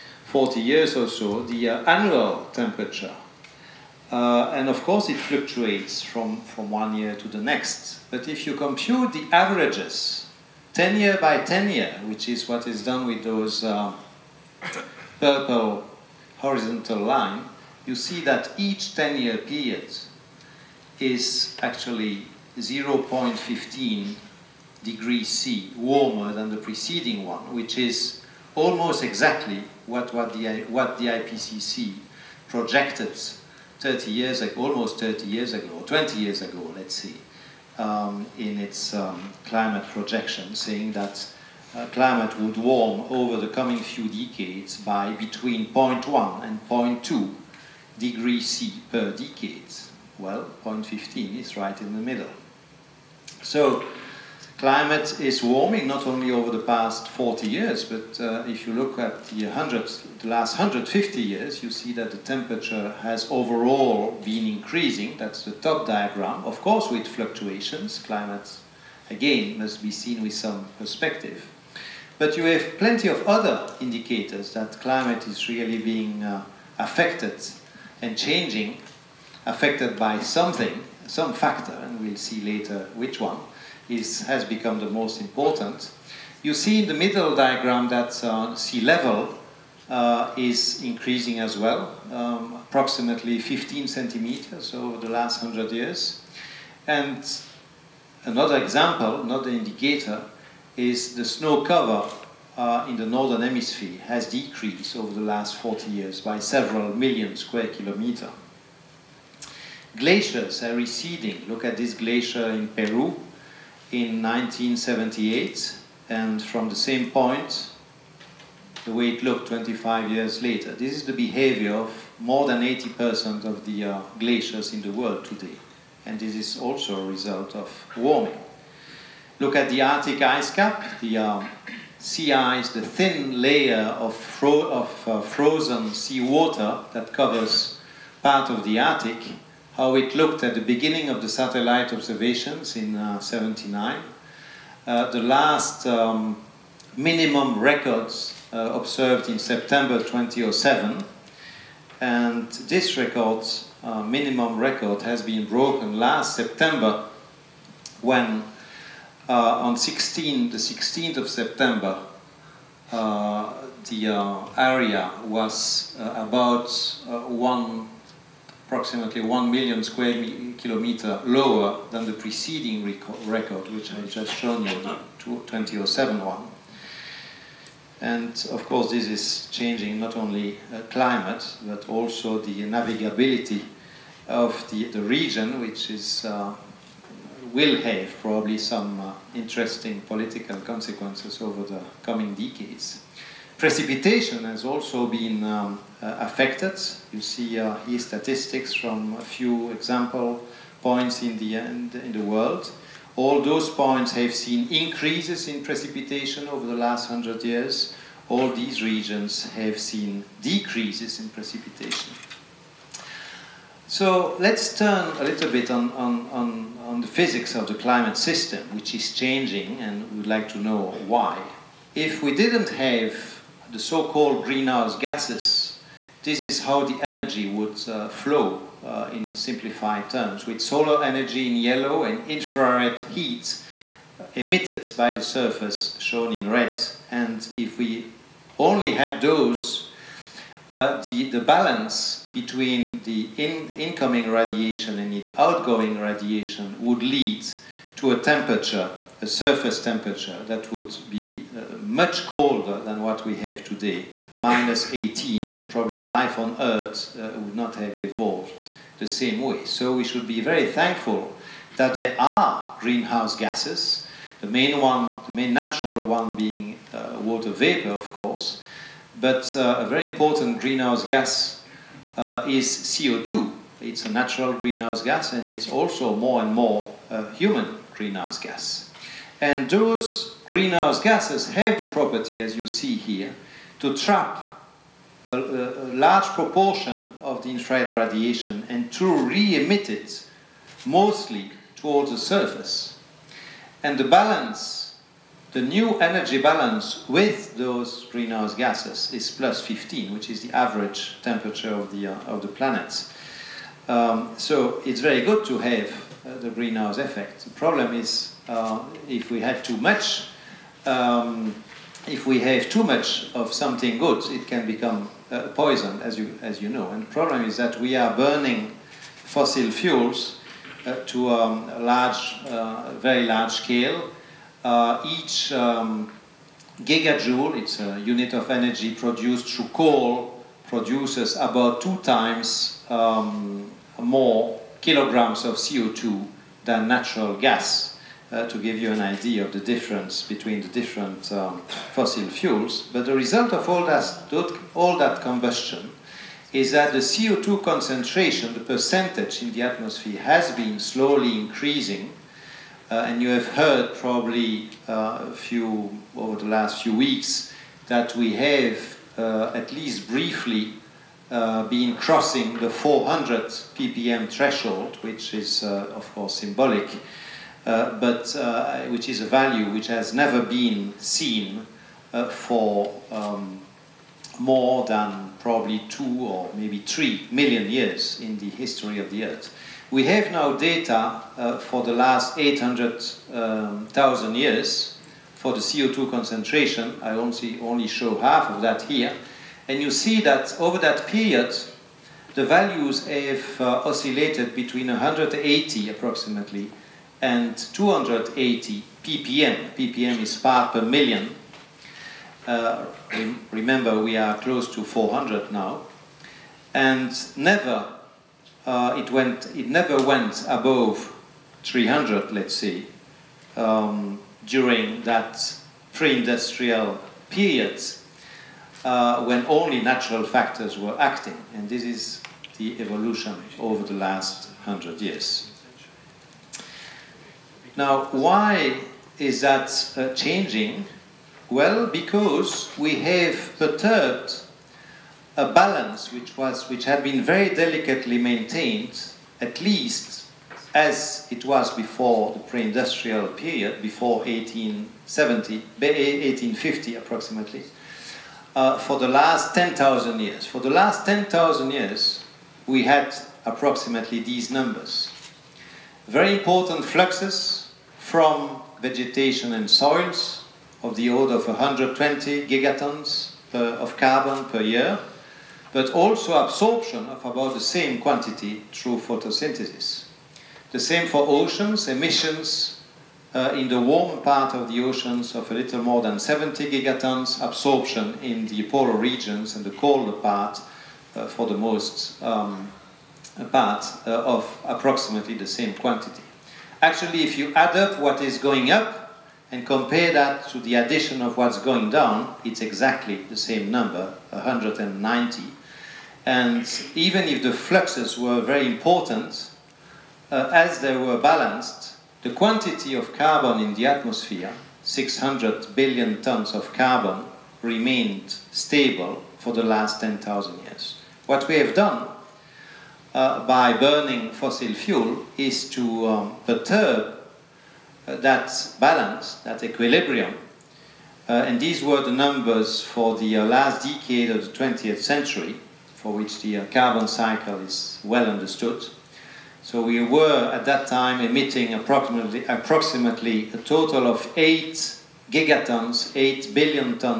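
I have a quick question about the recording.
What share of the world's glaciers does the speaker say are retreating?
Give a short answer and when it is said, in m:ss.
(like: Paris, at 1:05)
more than 80%, at 2:02.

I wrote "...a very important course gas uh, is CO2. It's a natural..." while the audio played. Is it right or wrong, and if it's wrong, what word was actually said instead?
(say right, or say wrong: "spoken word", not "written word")
wrong: "greenhouse", not "course".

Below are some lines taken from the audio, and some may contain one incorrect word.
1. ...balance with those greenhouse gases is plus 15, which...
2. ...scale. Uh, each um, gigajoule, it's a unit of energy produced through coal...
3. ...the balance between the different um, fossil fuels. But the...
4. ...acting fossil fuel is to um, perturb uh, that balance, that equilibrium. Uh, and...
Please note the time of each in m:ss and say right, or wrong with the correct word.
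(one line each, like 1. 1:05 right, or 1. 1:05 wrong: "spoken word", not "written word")
1. 4:56 right
2. 5:23 right
3. 5:39 wrong: "difference", not "balance"
4. 8:33 wrong: "burning", not "acting".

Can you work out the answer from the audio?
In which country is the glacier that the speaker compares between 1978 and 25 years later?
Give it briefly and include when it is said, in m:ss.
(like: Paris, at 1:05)
Peru, at 1:52.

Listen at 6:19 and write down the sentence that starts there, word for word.
We have now data uh, for the last 800,000 um, years for the CO2 concentration.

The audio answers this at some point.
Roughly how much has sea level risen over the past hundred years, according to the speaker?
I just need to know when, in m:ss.
1:33.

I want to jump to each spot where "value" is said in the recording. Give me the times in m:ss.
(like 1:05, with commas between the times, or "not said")
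6:09, 6:32.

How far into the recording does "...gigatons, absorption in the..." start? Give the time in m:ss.
7:56.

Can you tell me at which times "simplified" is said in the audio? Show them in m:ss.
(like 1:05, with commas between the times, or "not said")
3:49.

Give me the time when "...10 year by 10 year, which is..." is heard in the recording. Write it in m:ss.
0:10.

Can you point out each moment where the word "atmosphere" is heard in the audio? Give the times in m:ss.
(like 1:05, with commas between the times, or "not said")
5:49, 8:23.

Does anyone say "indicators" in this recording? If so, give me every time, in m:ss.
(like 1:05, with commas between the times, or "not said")
1:13, 1:39.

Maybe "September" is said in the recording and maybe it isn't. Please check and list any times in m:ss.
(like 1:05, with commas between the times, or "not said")
2:29, 2:36, 2:41.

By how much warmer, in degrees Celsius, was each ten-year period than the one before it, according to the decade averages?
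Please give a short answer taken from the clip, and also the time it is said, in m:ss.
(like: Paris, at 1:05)
0.15, at 0:22.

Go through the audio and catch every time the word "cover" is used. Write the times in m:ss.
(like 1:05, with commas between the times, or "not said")
1:41, 2:17.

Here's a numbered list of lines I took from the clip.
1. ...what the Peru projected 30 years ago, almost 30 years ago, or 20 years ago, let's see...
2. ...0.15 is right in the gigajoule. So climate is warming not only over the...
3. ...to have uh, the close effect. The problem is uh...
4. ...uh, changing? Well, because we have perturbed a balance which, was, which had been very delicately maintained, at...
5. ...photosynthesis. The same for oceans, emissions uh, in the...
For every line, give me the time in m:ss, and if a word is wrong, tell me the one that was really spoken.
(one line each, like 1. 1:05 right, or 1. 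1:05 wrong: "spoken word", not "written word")
1. 0:30 wrong: "IPCC", not "Peru"
2. 0:50 wrong: "middle", not "gigajoule"
3. 5:05 wrong: "greenhouse", not "close"
4. 7:09 right
5. 7:48 right.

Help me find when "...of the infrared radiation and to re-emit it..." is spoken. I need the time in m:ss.
4:47.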